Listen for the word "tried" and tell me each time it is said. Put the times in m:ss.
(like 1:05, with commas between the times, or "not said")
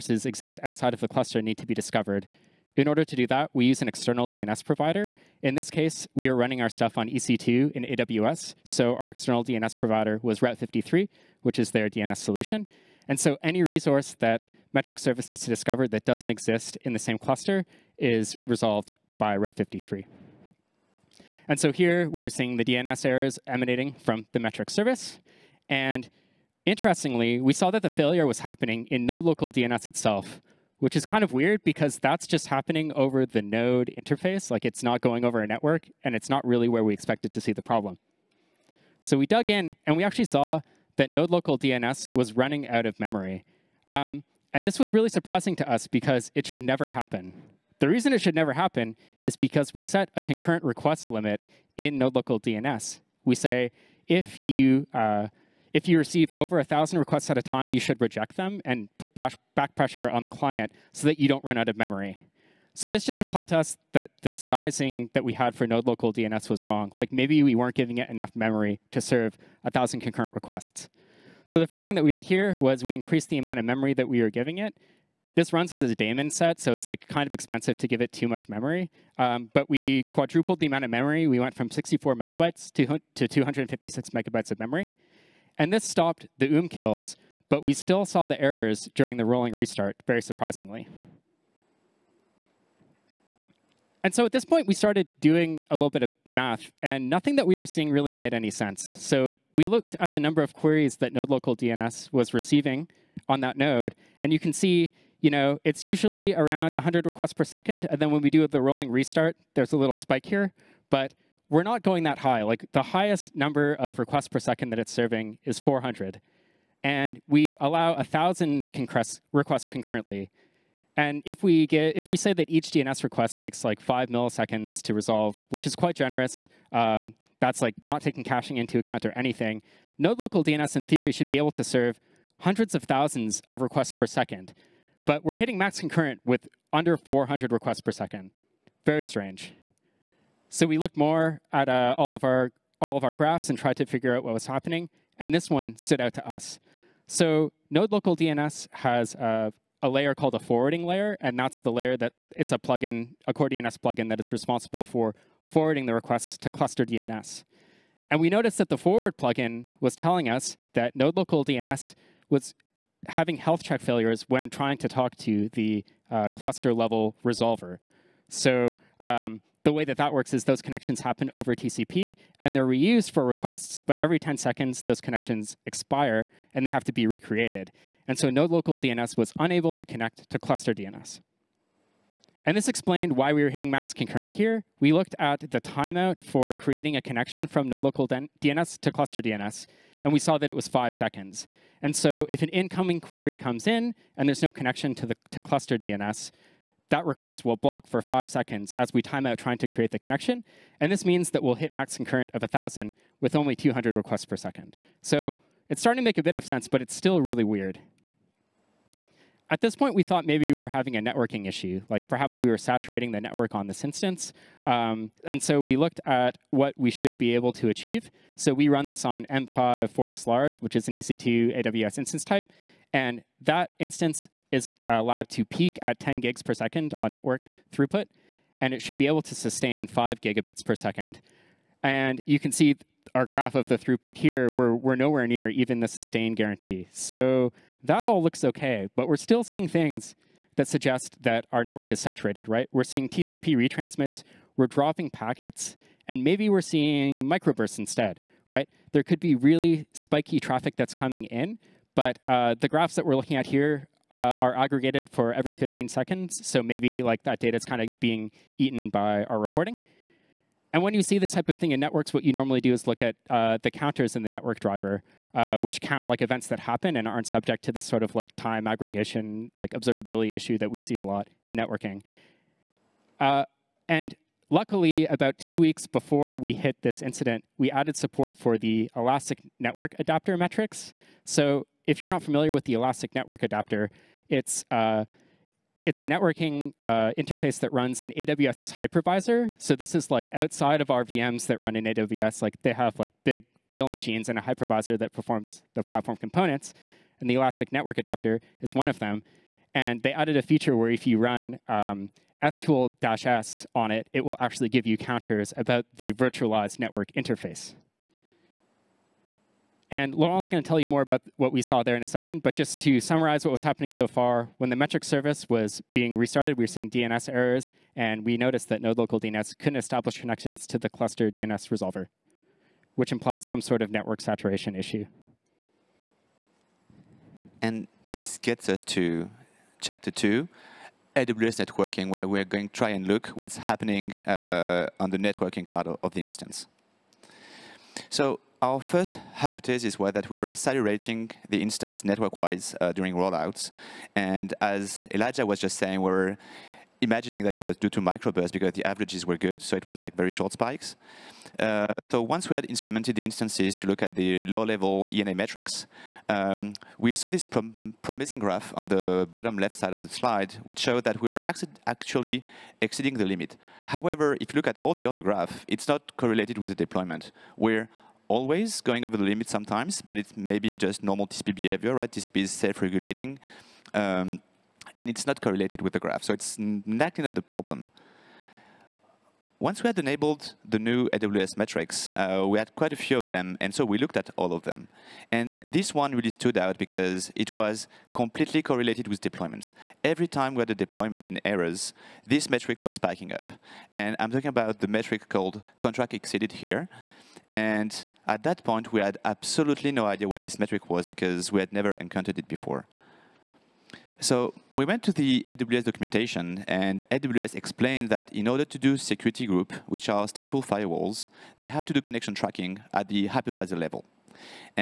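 2:23.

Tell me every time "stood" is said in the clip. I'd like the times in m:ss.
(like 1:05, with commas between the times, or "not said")
2:25, 6:26.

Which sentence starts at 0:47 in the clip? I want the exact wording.
The reason it should never happen is because we set a concurrent request limit in node local DNS.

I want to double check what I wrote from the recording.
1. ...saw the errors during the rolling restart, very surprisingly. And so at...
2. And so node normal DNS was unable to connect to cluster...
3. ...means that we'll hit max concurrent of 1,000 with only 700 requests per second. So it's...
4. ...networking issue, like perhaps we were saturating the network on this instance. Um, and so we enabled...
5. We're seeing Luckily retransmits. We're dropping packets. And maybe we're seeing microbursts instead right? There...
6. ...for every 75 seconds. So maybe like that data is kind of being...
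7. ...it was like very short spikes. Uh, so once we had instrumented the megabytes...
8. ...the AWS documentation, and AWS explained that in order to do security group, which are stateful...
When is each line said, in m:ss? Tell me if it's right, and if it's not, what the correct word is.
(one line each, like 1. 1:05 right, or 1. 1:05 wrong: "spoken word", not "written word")
1. 1:28 right
2. 2:58 wrong: "local", not "normal"
3. 3:21 wrong: "200", not "700"
4. 3:30 wrong: "looked", not "enabled"
5. 4:02 wrong: "TCP", not "Luckily"
6. 4:15 wrong: "15", not "75"
7. 5:49 wrong: "instances", not "megabytes"
8. 6:45 right.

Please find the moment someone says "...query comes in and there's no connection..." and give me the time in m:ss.
3:12.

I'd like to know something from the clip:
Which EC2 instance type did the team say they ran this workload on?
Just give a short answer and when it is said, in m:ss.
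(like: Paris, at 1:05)
M5 4xlarge, at 3:39.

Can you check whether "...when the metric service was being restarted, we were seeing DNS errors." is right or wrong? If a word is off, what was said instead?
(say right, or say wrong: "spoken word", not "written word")
right.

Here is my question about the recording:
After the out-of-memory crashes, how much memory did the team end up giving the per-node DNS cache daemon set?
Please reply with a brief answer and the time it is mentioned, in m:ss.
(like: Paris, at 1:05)
256 megabytes, at 1:23.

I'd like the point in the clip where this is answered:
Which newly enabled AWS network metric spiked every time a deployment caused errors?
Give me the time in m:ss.
6:35.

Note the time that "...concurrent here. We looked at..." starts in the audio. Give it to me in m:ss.
3:03.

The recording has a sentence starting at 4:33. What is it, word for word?
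Uh, and Luckily, about two weeks before we hit this incident, we added support for the Elastic Network Adapter metrics.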